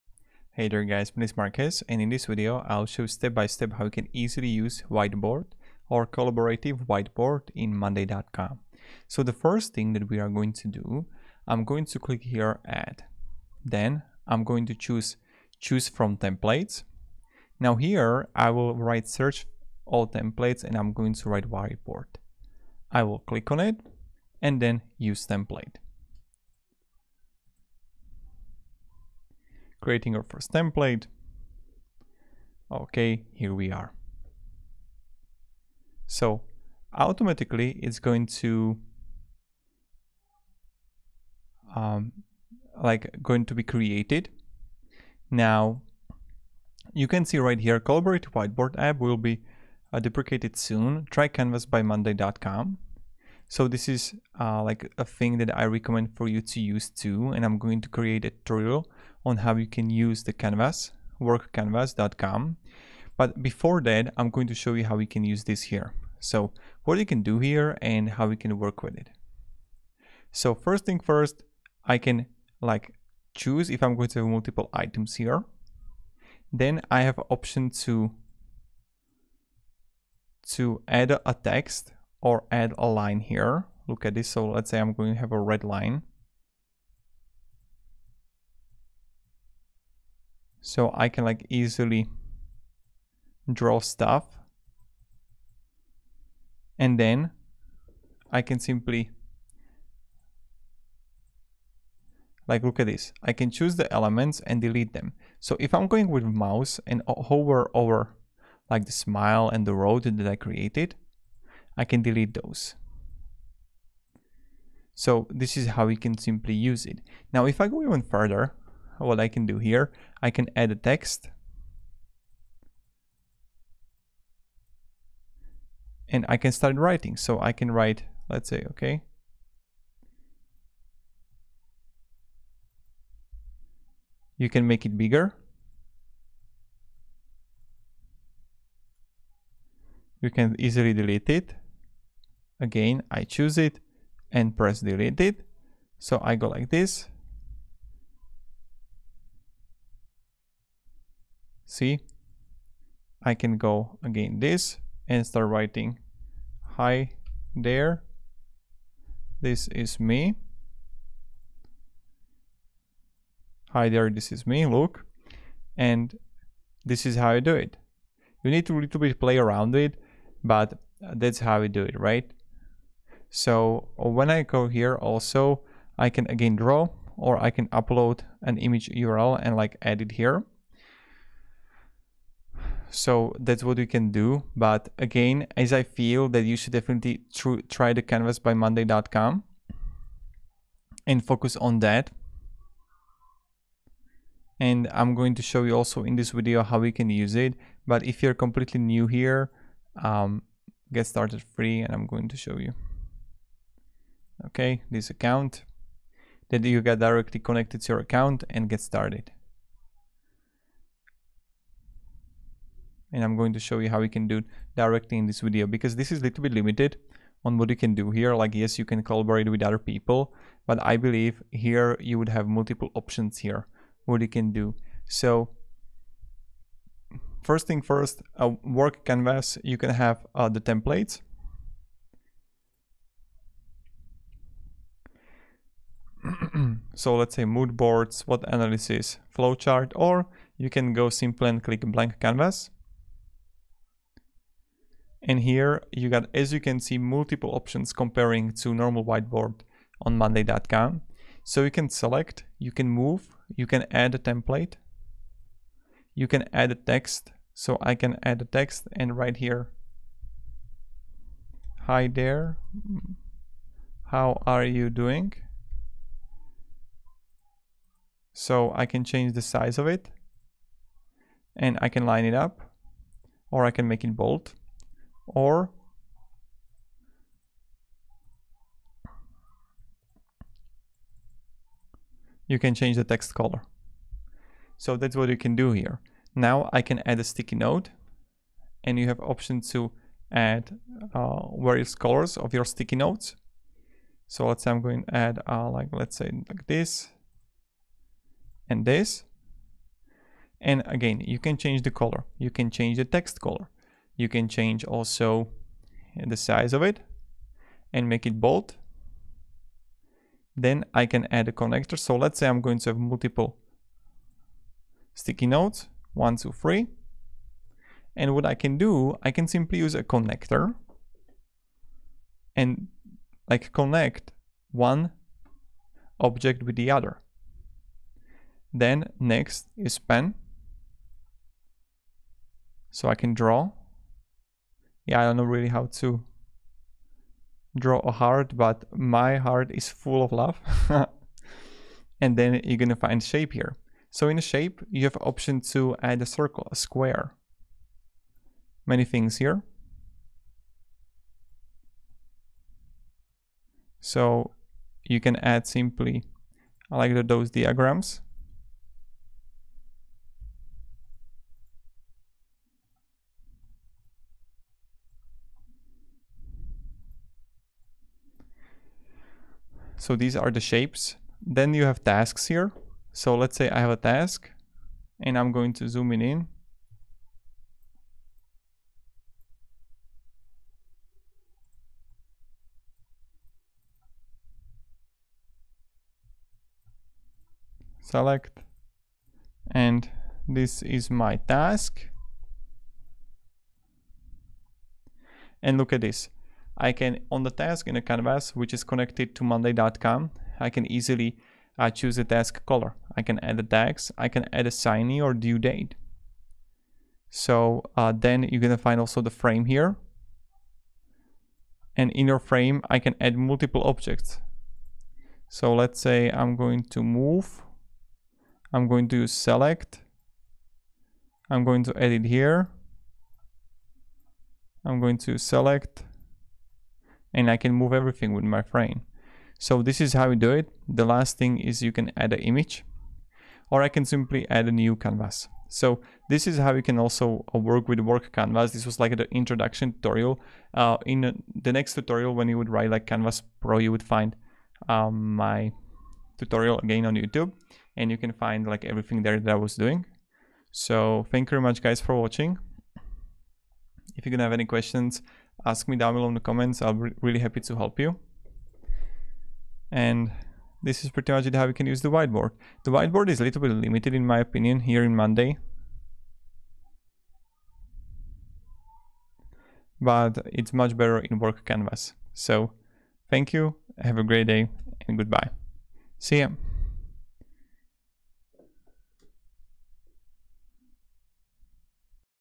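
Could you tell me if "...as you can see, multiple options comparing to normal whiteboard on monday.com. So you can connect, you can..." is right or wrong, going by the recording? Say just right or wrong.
wrong.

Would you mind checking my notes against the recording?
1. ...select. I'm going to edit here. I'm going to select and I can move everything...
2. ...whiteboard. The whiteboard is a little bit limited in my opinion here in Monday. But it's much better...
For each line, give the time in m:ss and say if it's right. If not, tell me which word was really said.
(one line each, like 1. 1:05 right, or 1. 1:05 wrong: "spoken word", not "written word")
1. 6:59 right
2. 7:42 right.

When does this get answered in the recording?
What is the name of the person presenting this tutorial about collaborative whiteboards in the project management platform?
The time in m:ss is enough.
0:01.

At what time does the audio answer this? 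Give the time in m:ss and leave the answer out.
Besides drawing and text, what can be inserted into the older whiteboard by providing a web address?
2:58.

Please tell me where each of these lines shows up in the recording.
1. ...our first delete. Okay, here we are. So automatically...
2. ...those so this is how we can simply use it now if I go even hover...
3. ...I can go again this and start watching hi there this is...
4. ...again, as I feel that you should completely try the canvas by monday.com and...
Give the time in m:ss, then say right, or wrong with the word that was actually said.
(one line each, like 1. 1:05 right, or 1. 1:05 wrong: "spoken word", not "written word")
1. 0:30 wrong: "template", not "delete"
2. 1:52 wrong: "further", not "hover"
3. 2:33 wrong: "writing", not "watching"
4. 3:04 wrong: "definitely", not "completely".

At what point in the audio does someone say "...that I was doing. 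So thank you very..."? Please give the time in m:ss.
7:29.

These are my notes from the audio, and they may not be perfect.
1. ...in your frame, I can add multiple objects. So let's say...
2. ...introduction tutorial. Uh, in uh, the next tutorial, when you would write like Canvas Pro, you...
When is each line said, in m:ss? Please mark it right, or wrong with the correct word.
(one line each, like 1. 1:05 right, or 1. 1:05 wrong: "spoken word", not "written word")
1. 6:52 right
2. 7:19 right.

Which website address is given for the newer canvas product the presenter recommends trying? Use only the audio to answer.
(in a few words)
workcanvas.com.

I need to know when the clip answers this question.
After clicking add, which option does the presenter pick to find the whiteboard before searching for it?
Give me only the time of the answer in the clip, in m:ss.
0:15.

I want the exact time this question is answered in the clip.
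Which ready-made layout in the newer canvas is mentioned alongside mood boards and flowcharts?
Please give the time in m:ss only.
4:01.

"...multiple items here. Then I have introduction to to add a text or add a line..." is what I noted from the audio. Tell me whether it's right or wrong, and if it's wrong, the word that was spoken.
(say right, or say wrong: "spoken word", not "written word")
wrong: "option", not "introduction".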